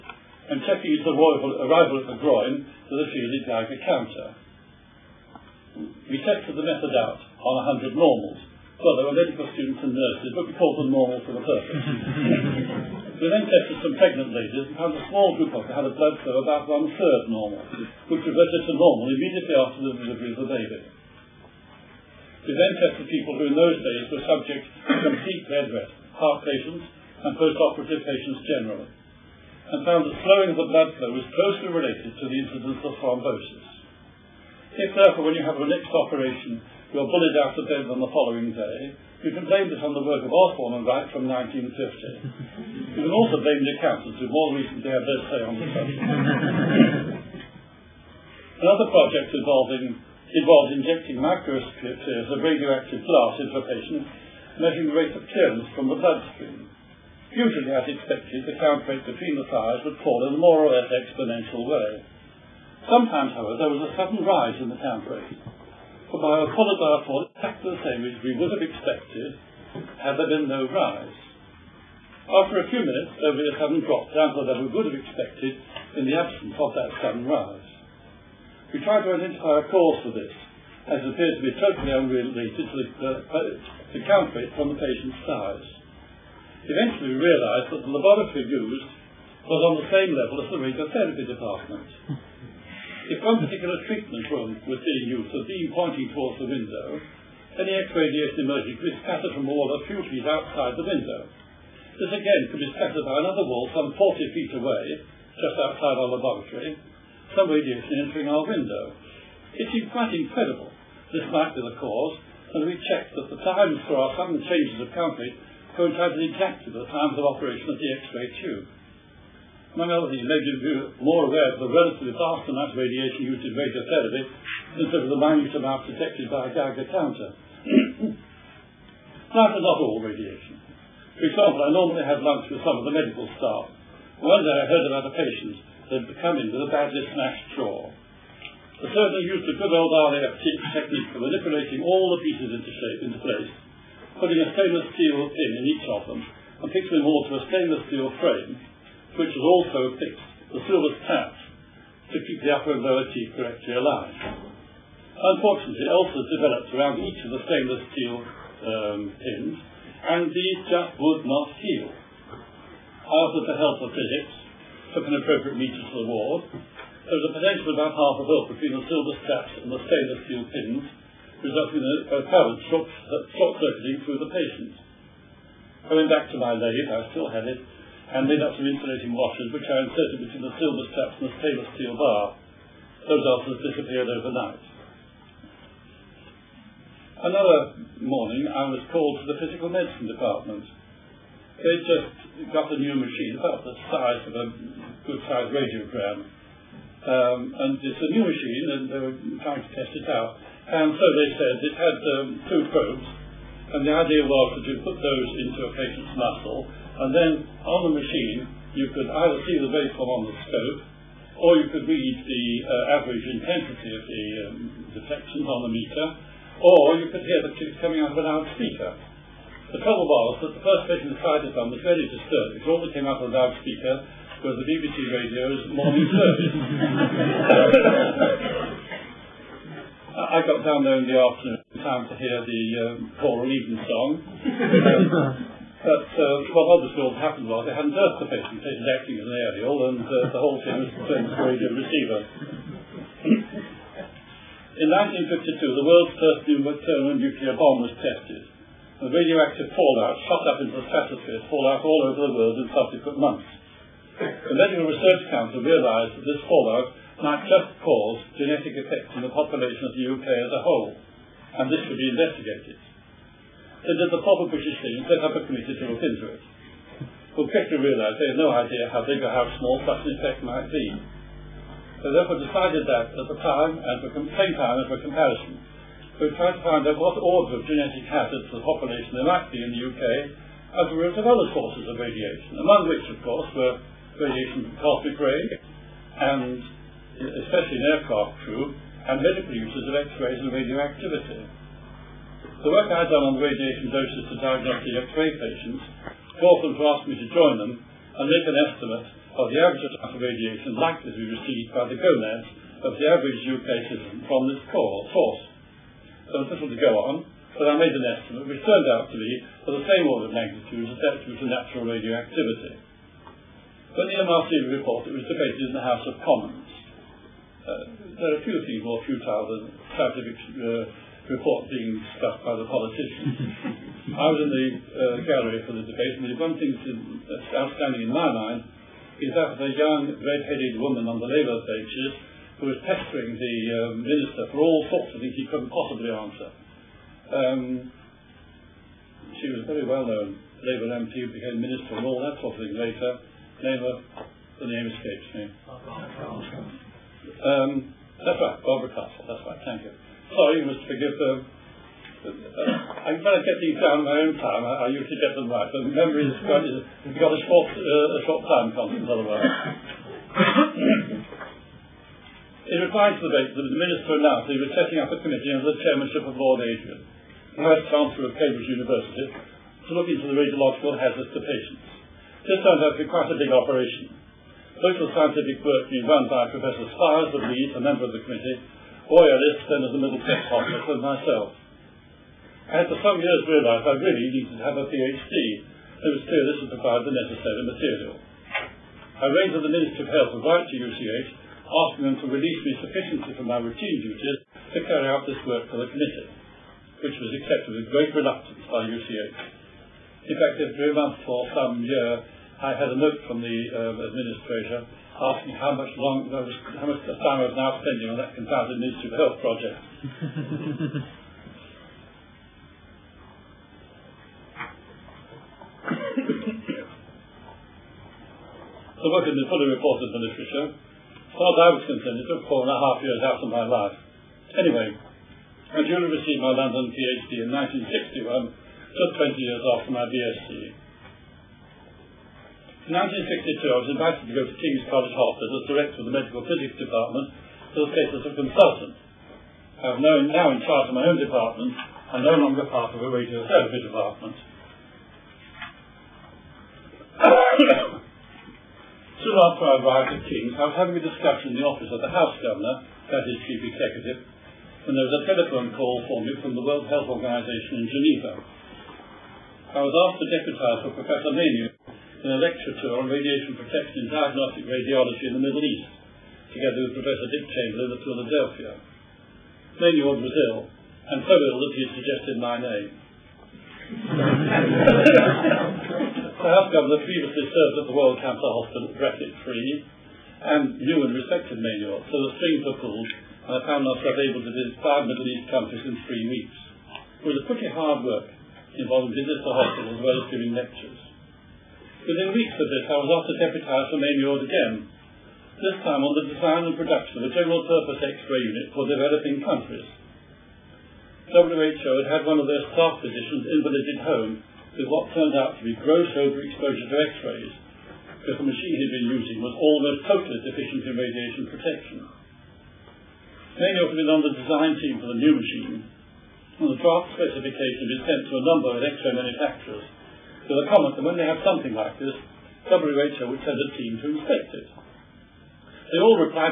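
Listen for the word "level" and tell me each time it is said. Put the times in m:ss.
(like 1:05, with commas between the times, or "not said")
1:14, 1:30.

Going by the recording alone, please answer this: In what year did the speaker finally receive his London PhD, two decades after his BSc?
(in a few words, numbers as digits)
1961.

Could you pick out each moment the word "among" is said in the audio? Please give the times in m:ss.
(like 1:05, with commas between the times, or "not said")
1:59, 4:42.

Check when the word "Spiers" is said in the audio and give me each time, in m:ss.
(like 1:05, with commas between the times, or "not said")
6:16.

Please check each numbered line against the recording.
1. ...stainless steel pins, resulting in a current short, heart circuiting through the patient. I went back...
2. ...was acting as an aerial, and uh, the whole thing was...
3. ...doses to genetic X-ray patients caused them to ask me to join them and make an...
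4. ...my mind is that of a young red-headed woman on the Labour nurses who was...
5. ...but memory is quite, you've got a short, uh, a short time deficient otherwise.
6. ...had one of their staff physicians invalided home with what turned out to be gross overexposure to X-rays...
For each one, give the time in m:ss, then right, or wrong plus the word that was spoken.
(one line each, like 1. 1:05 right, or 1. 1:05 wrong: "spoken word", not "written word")
1. 2:49 wrong: "short", not "heart"
2. 3:58 right
3. 4:53 wrong: "diagnostic", not "genetic"
4. 5:28 wrong: "benches", not "nurses"
5. 5:55 wrong: "constant", not "deficient"
6. 8:22 right.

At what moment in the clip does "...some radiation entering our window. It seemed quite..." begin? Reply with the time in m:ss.
1:47.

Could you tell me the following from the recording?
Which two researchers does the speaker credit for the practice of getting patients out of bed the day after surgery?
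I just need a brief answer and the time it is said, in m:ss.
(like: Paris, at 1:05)
Osborn and Wright, at 0:40.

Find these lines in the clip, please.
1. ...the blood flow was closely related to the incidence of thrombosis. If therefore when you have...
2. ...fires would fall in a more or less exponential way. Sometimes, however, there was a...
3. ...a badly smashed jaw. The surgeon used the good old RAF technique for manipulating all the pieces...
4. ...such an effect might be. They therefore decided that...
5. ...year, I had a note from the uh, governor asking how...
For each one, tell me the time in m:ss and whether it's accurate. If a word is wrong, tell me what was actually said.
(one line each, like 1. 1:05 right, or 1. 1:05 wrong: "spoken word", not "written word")
1. 0:30 right
2. 0:59 right
3. 2:16 right
4. 4:29 right
5. 6:41 wrong: "administrator", not "governor".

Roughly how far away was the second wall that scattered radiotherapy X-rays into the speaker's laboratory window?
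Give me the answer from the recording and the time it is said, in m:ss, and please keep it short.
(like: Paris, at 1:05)
40 feet, at 1:43.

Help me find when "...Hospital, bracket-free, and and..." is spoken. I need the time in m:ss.
7:58.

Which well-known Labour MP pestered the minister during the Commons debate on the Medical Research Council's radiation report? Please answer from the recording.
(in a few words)
Barbara Castle.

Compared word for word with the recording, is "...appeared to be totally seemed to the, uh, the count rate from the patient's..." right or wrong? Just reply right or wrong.
wrong.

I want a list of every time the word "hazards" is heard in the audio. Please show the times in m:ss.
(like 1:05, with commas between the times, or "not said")
4:38, 6:10.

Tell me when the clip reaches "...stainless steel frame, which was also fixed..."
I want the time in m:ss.
2:27.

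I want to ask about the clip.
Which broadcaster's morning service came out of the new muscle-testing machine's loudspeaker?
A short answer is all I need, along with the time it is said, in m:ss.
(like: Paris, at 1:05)
BBC, at 3:44.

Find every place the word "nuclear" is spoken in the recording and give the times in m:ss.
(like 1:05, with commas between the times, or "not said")
4:07.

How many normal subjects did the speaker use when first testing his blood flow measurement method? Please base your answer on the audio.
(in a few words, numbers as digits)
100.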